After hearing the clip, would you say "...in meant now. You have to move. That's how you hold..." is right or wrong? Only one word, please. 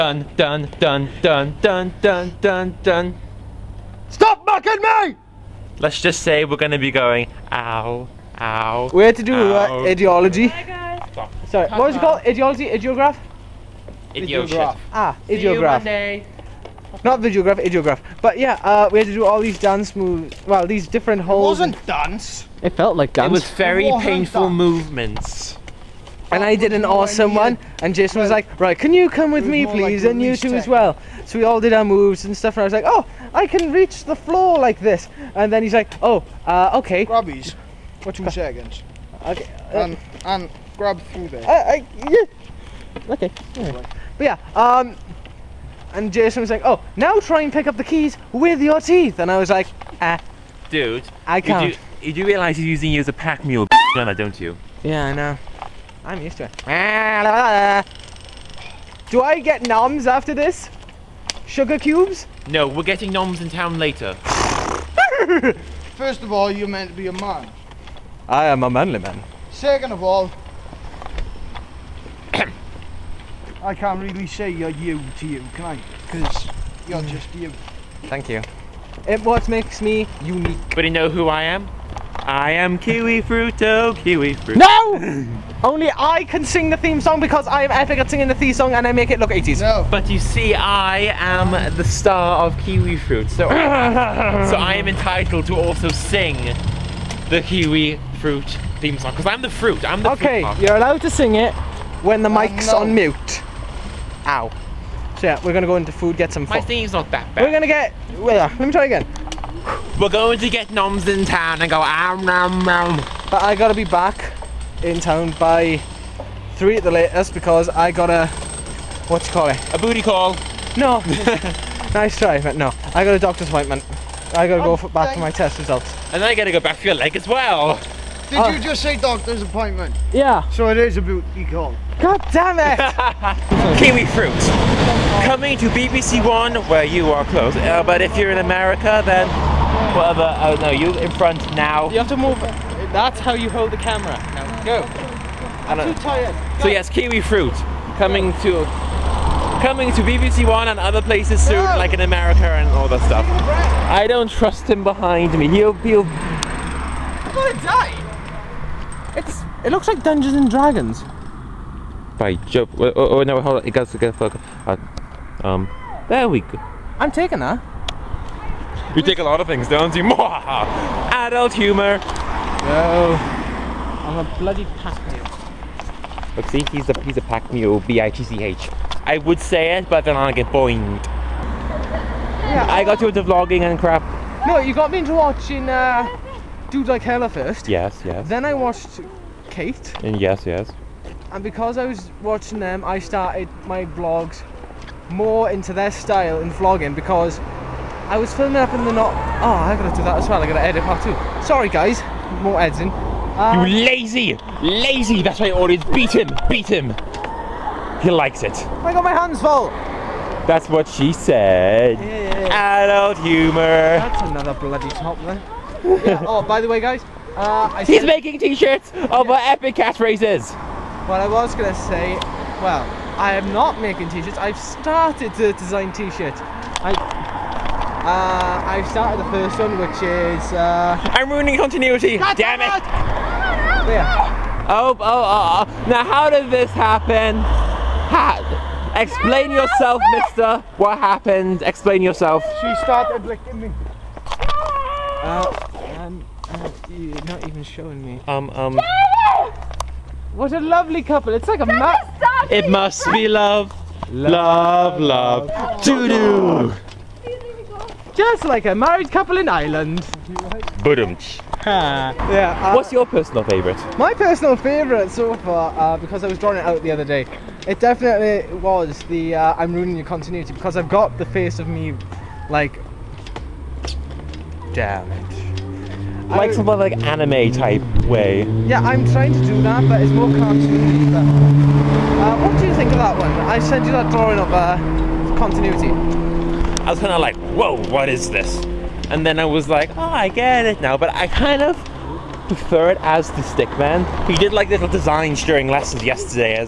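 wrong.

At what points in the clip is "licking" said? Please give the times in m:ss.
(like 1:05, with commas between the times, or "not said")
4:03.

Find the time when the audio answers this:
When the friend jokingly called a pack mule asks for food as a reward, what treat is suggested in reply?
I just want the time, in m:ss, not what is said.
1:01.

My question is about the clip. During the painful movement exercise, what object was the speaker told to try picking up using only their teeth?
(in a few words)
Keys.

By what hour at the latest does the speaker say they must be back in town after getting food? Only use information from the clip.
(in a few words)
3.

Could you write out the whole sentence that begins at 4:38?
Yeah, I'm trying to do that, but it's more cartoony.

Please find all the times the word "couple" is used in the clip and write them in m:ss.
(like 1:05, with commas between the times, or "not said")
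4:11, 4:19.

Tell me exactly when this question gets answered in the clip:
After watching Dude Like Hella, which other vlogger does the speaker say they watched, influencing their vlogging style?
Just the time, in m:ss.
3:09.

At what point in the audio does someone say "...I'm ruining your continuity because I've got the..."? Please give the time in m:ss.
4:29.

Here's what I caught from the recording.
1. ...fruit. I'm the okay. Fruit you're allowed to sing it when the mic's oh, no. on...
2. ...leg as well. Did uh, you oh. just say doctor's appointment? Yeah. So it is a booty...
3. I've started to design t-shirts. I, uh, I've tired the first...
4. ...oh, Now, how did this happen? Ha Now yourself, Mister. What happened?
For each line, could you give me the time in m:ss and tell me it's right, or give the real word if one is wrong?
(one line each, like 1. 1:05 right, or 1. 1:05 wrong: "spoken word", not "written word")
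1. 1:39 right
2. 2:06 right
3. 3:44 wrong: "started", not "tired"
4. 3:55 wrong: "Explain", not "Now".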